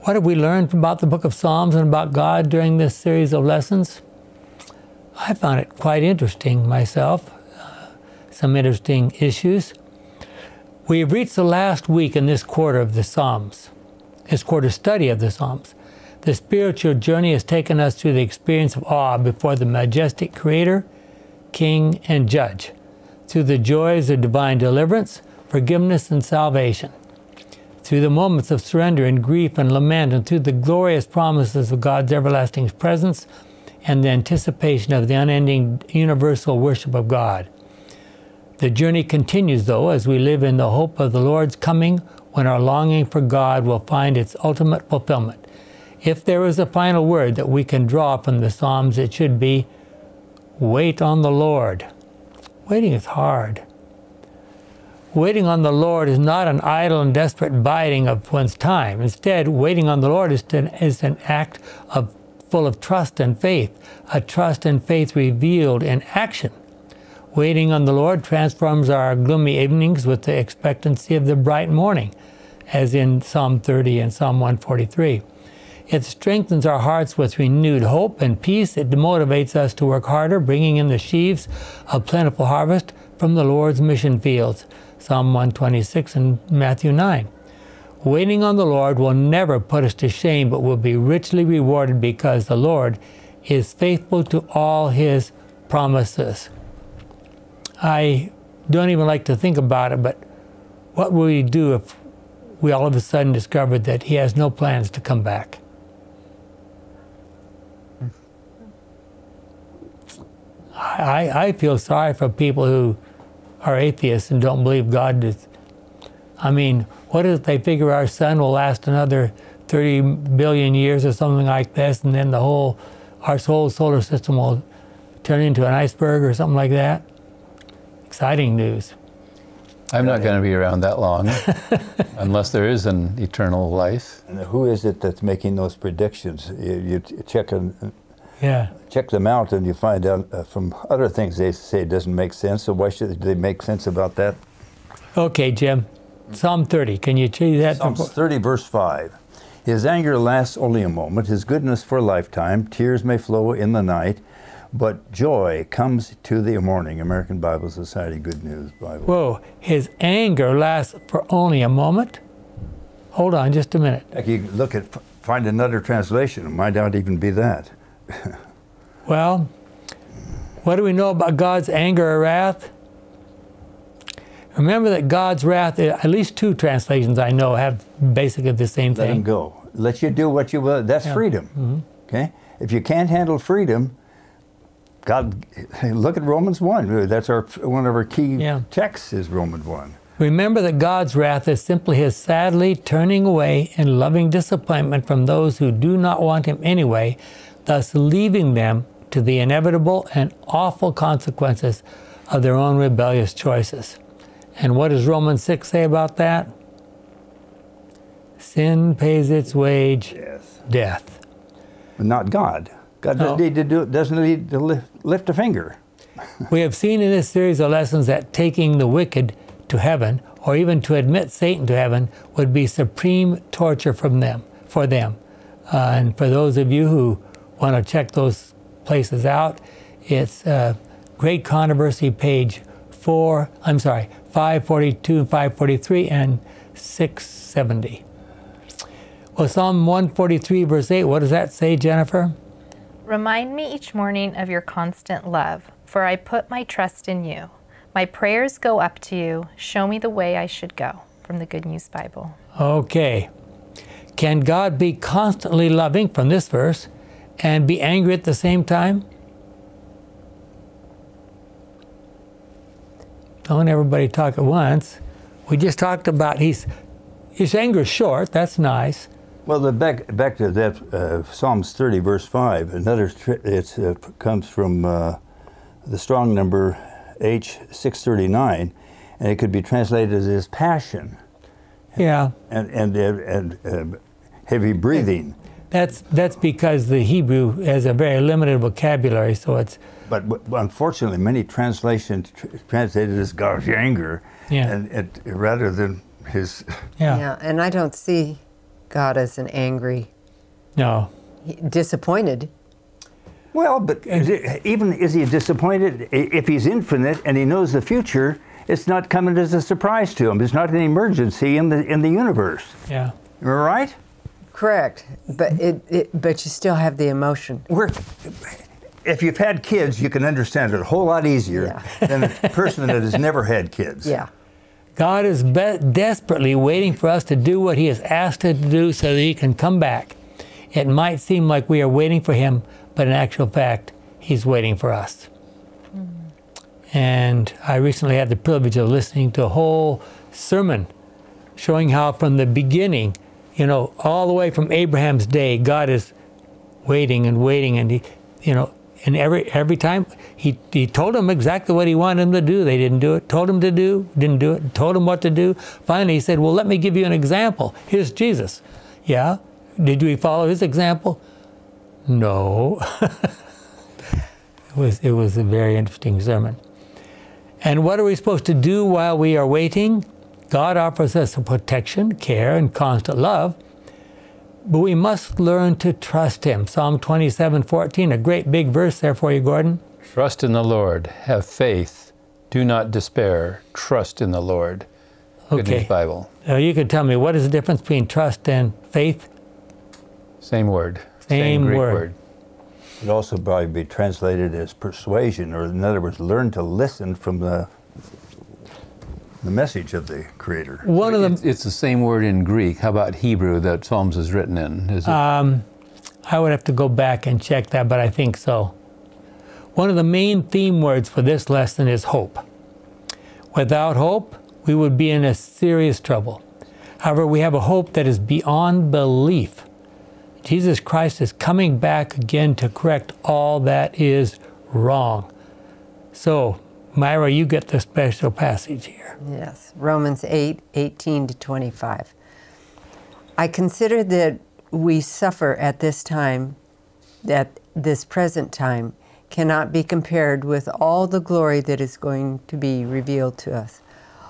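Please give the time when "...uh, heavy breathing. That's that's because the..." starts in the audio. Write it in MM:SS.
04:43.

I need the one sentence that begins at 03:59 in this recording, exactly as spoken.
Well, Psalm 143, verse 8, what does that say, Jennifer?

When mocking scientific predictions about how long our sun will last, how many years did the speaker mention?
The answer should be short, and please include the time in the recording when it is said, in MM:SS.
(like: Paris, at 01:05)
30 billion, at 01:59.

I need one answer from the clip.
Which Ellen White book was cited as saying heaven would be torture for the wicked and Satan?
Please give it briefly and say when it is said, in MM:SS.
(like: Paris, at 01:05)
Great Controversy, at 03:51.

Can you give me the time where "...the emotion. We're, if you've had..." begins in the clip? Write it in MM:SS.
05:16.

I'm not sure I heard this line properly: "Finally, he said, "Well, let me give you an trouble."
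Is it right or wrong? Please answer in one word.
wrong.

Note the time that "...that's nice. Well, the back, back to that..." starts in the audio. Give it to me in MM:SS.
04:28.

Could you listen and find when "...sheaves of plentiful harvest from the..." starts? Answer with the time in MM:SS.
01:20.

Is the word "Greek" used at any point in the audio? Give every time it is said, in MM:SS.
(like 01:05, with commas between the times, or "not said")
06:31, 06:42.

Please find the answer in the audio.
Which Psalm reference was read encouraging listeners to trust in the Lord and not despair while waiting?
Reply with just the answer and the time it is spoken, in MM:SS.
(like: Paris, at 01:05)
Psalm 27:14, at 06:16.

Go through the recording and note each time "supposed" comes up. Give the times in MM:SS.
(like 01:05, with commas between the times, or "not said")
06:08.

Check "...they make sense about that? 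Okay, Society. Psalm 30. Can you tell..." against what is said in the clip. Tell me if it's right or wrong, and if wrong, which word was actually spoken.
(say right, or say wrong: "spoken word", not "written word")
wrong: "Jim", not "Society".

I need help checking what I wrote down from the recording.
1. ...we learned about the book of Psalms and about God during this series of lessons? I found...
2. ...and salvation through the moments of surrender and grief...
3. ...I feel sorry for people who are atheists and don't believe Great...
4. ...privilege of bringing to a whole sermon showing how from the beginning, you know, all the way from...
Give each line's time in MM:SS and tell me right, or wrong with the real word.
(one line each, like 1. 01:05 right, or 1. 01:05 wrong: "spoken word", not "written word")
1. 00:00 right
2. 00:26 right
3. 01:51 wrong: "God", not "Great"
4. 05:38 wrong: "listening", not "bringing".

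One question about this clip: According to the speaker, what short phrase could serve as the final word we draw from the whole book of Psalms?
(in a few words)
Wait on the Lord.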